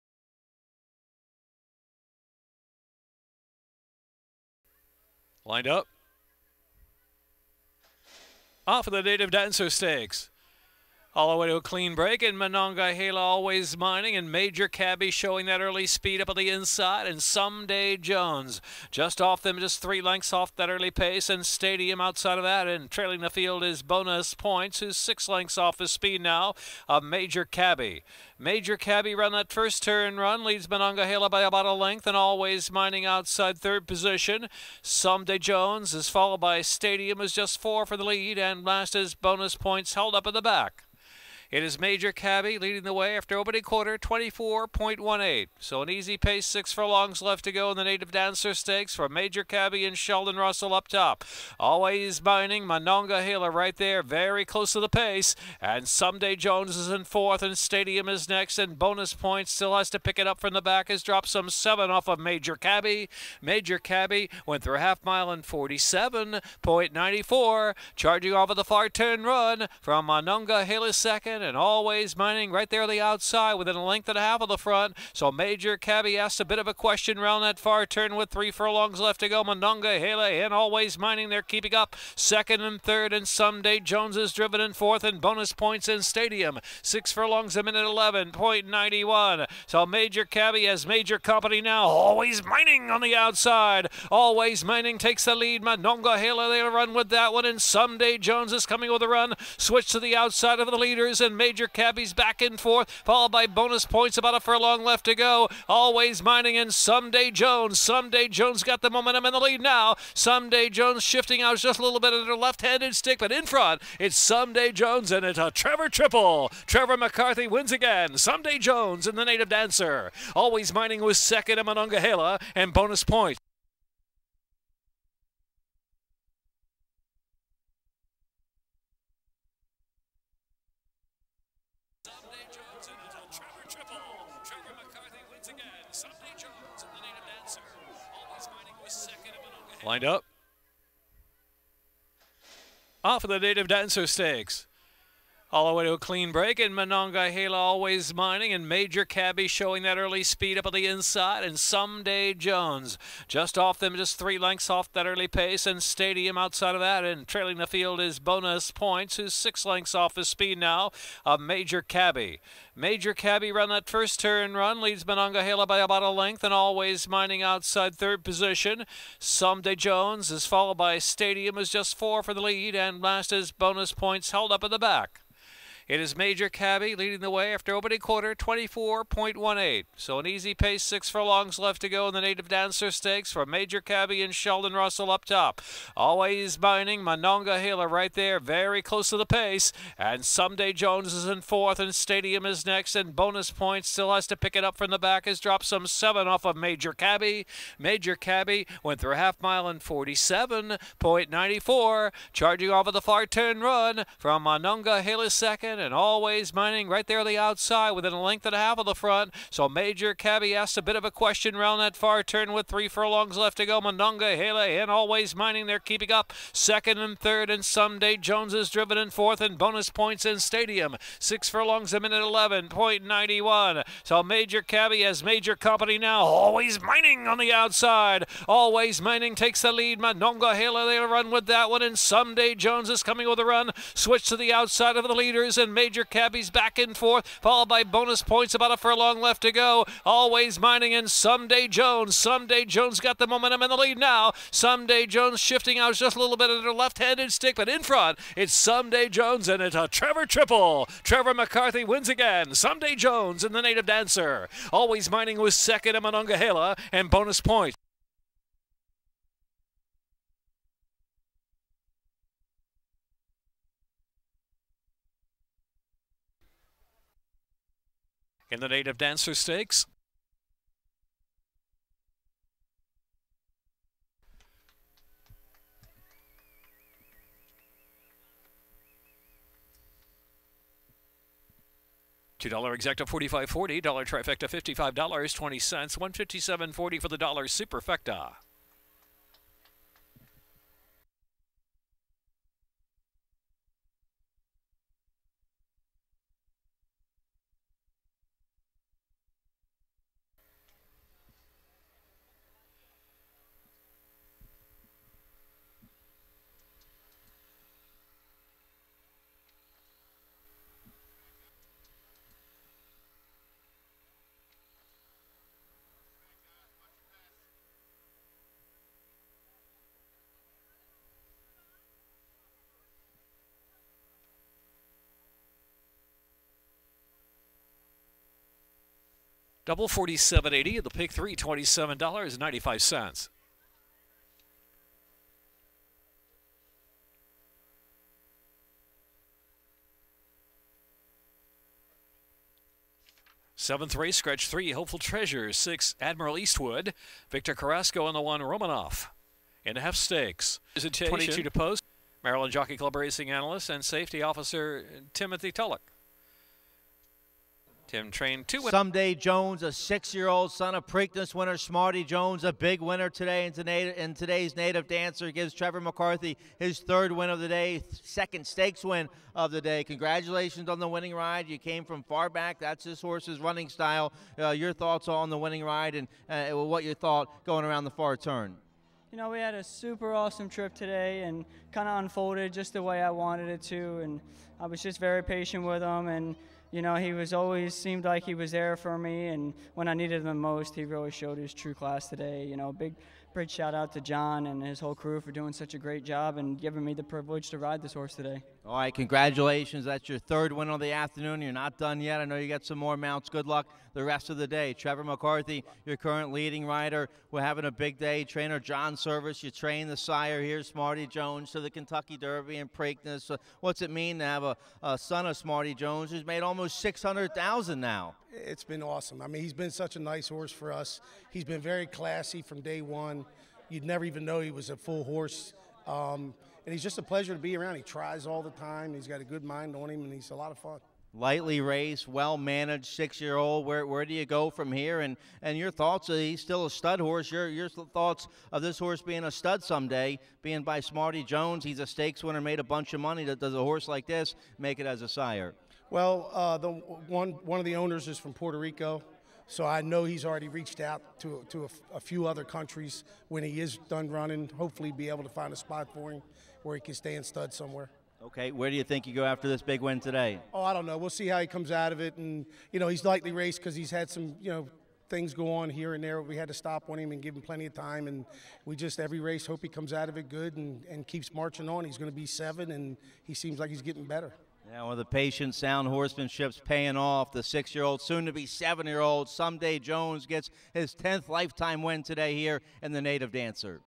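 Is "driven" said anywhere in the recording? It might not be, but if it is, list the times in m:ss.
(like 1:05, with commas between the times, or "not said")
1:24, 3:38.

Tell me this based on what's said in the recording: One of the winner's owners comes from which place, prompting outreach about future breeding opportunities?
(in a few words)
Puerto Rico.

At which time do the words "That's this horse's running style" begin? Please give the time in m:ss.
6:12.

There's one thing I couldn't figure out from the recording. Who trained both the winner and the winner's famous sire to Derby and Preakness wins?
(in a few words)
John Servis.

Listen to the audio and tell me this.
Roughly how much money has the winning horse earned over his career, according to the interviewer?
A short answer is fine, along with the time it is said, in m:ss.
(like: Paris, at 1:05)
600,000, at 6:56.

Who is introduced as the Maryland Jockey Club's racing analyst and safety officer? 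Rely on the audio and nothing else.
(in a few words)
Timothy Tullock.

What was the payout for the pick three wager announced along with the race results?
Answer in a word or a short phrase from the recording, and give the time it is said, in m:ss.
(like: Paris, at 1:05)
$27.95, at 5:31.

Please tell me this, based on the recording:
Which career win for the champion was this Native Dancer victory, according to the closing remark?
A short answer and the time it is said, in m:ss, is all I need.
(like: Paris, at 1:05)
10th, at 8:00.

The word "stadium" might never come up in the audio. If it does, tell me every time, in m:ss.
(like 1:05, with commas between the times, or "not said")
0:21, 0:36, 0:57, 1:26, 2:35, 2:50, 3:11, 3:40.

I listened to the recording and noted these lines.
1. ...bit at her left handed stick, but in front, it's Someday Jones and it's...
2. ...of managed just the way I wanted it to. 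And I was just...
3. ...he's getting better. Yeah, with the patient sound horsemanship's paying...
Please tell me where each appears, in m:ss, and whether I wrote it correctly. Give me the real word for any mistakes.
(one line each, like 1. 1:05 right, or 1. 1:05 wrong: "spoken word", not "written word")
1. 4:06 right
2. 6:21 wrong: "unfolded", not "managed"
3. 7:53 right.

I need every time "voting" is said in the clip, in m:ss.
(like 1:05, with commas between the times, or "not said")
not said.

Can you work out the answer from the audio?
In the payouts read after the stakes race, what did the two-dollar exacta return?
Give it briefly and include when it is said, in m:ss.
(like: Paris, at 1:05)
$45.40, at 4:43.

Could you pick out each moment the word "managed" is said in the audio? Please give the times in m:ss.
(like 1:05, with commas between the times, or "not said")
7:12.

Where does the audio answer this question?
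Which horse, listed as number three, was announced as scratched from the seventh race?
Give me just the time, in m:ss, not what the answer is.
5:44.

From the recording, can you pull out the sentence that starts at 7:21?
He's a stakes winner, made a bunch of money.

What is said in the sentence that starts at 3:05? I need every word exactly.
Always mining Manonga Hila right there, very close to the pace.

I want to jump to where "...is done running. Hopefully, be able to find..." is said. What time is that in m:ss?
7:33.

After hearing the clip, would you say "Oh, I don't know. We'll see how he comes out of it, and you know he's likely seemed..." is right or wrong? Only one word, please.
wrong.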